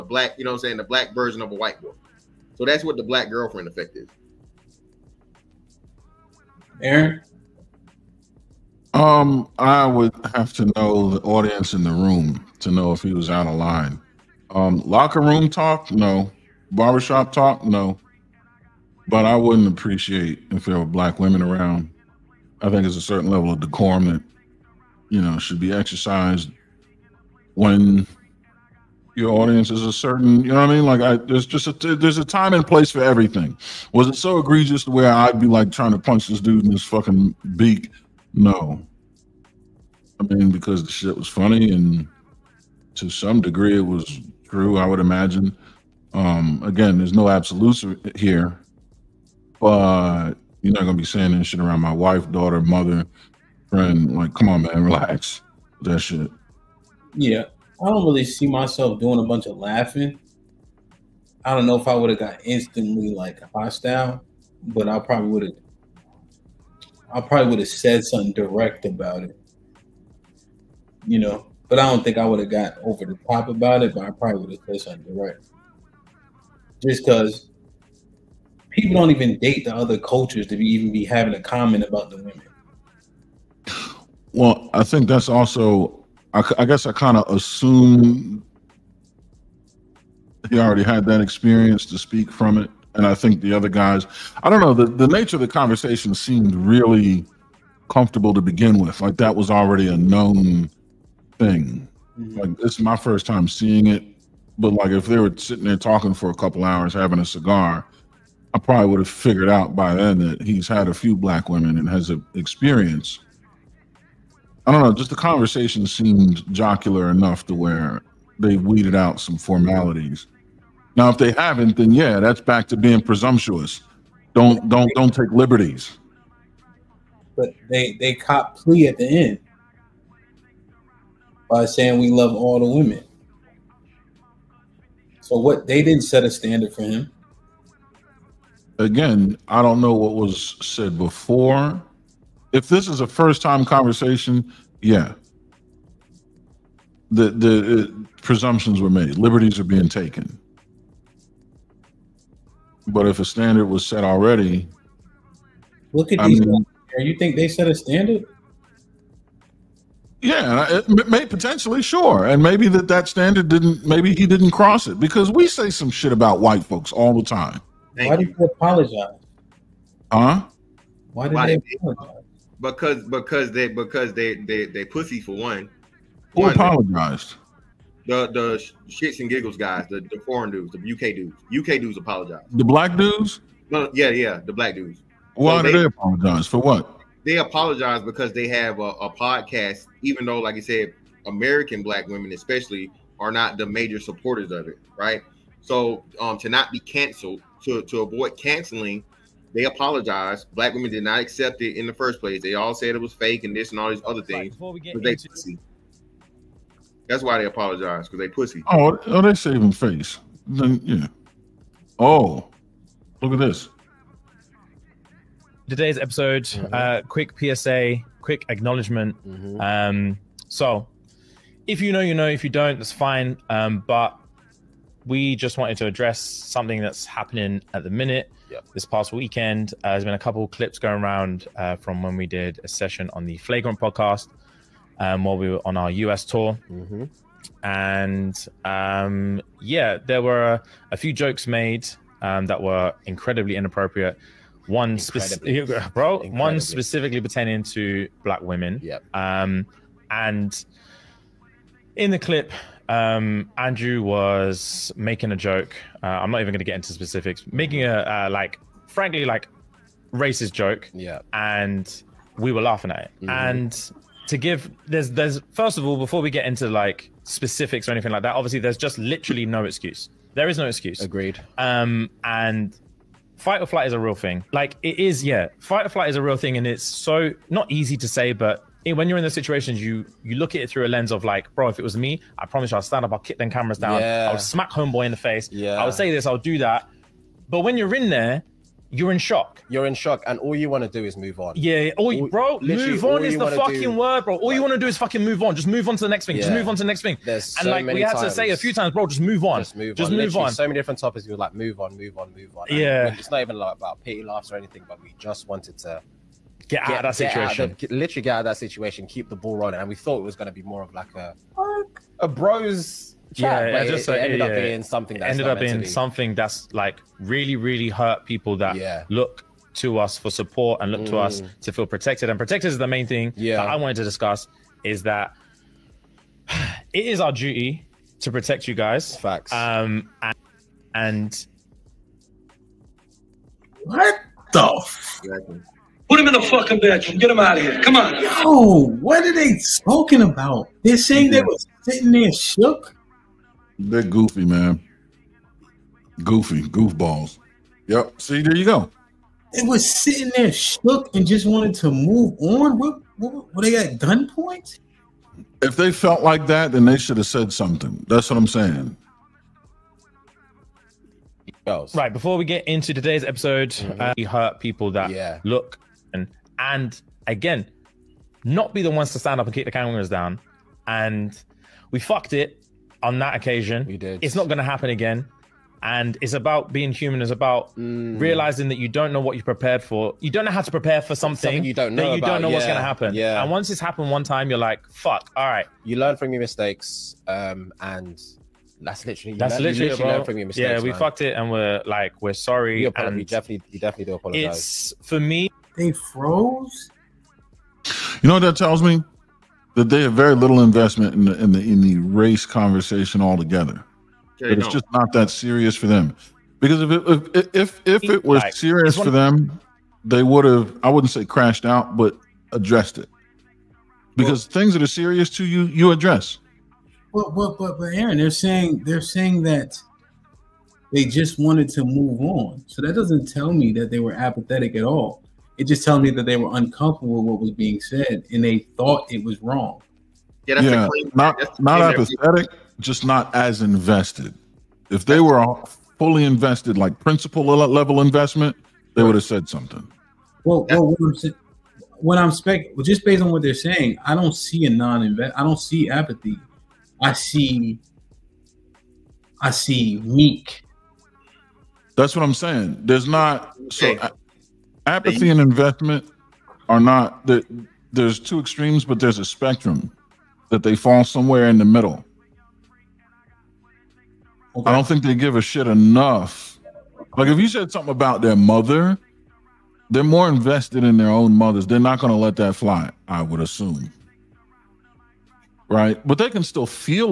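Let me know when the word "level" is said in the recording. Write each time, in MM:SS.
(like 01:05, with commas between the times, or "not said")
00:23, 07:17.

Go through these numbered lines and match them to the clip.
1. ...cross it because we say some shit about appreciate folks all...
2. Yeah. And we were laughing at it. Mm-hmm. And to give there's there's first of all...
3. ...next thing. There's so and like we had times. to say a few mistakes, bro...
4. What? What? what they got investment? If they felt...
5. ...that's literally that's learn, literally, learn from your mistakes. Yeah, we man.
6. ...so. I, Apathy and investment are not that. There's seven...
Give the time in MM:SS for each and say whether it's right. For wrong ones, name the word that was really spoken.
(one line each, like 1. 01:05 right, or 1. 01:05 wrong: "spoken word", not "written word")
1. 02:44 wrong: "white", not "appreciate"
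2. 04:20 right
3. 04:56 wrong: "times", not "mistakes"
4. 05:52 wrong: "gunpoint", not "investment"
5. 06:28 right
6. 07:33 wrong: "two", not "seven".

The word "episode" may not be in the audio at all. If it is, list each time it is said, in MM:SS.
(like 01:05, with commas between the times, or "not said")
03:35, 06:03.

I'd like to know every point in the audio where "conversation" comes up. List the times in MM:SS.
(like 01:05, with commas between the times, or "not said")
01:35, 01:55, 02:23, 06:42.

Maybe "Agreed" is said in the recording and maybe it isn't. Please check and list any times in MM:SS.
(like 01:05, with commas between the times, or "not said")
04:30.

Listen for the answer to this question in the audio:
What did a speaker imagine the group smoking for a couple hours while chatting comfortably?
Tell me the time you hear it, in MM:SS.
01:47.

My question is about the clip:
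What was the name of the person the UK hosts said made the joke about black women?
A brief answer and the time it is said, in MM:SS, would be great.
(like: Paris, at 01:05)
Andrew, at 04:13.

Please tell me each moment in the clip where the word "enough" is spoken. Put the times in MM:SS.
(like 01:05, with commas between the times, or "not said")
01:57, 07:45.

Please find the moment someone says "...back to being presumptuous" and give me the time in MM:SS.
02:02.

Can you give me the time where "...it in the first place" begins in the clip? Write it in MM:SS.
03:21.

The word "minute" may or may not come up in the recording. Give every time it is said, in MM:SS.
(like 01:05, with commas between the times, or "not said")
03:47.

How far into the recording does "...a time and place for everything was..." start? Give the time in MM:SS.
00:32.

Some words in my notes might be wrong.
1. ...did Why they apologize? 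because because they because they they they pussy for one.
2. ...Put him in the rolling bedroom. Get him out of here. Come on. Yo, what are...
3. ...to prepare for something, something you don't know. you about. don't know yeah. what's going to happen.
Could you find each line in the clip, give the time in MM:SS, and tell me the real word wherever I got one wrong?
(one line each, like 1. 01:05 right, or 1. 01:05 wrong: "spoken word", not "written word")
1. 02:51 right
2. 05:36 wrong: "fucking", not "rolling"
3. 06:20 right.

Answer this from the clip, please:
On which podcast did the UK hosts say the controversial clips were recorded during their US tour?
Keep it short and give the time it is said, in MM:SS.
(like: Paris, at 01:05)
Flagrant, at 03:53.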